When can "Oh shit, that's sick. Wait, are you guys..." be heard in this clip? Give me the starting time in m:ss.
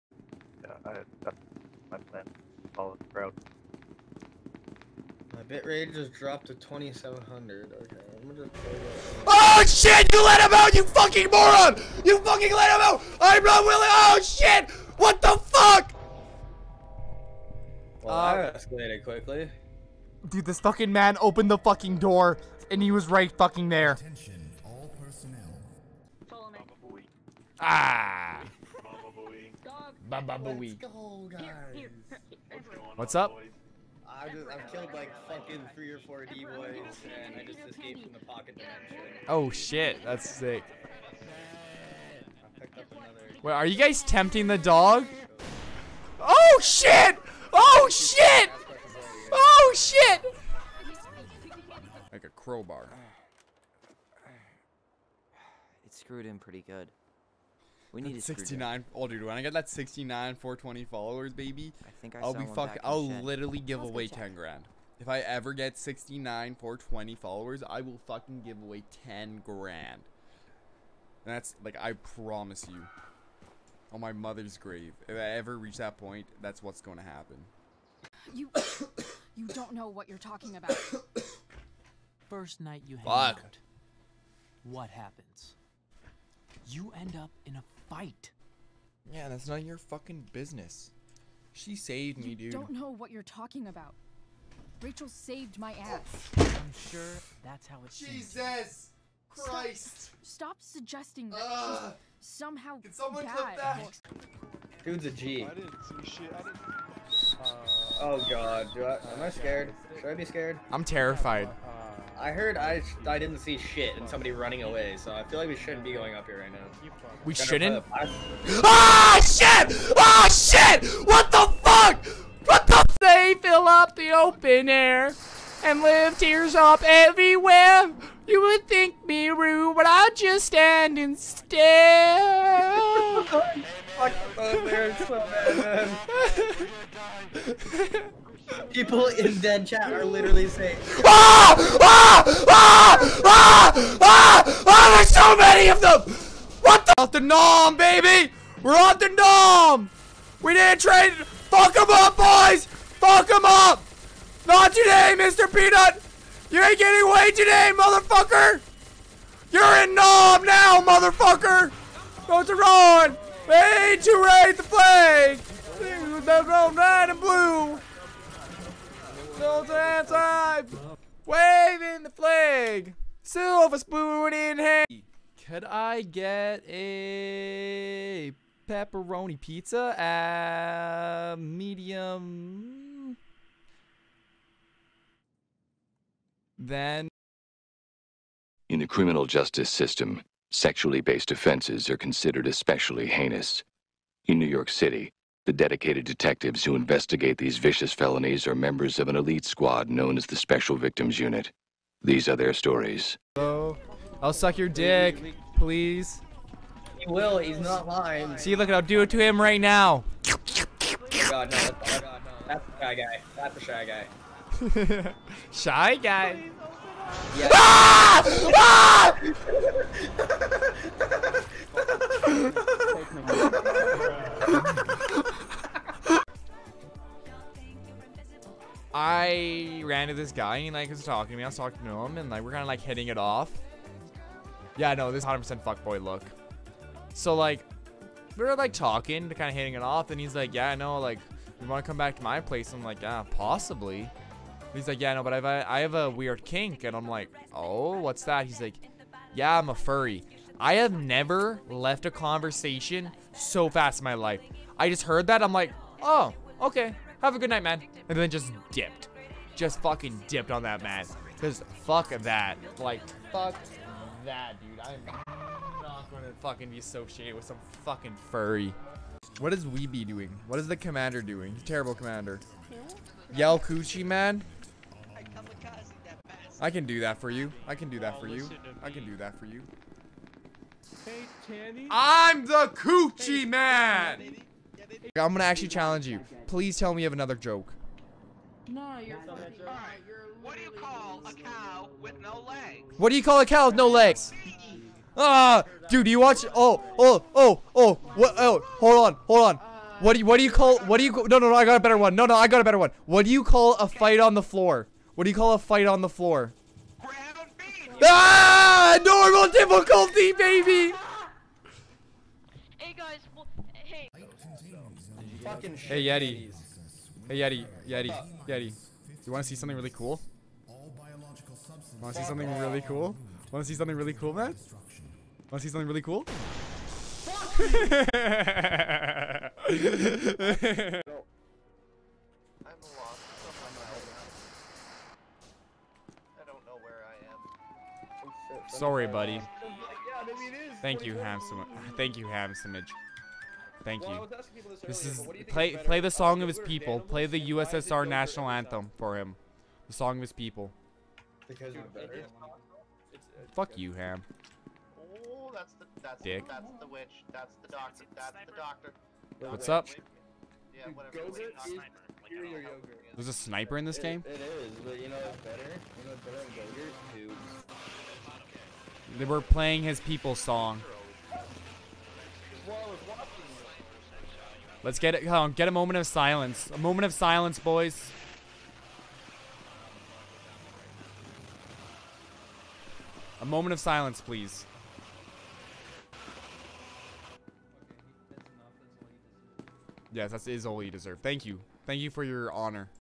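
0:39.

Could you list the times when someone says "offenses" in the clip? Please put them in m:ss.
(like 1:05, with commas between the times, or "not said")
3:11.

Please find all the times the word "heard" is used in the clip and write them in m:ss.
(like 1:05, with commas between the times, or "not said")
1:52, 4:15.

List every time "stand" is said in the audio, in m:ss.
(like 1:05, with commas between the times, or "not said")
2:10.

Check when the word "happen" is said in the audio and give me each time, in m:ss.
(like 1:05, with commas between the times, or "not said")
1:17, 1:24.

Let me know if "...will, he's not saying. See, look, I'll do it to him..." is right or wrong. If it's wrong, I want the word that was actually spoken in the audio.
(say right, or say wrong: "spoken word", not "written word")
wrong: "lying", not "saying".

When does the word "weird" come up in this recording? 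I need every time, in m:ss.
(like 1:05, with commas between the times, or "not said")
4:06.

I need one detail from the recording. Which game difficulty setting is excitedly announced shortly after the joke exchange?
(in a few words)
Normal.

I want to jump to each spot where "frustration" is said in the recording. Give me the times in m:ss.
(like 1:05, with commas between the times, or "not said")
not said.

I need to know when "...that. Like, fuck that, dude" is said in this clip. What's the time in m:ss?
4:22.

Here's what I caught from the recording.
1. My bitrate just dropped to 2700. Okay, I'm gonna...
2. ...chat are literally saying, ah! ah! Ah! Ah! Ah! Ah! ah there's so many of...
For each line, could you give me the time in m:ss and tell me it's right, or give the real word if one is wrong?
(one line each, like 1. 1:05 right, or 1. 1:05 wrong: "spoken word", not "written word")
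1. 0:05 right
2. 2:19 right.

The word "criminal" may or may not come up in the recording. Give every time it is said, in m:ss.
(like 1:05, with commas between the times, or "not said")
3:08.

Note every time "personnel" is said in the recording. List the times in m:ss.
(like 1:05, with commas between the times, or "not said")
0:25.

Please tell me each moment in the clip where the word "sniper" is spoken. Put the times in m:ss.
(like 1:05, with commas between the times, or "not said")
6:03.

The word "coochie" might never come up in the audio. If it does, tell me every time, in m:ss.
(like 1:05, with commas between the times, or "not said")
4:33, 4:42.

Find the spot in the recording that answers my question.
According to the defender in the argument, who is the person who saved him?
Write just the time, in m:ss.
1:34.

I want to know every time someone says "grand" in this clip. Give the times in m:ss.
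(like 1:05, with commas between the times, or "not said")
1:04, 1:09.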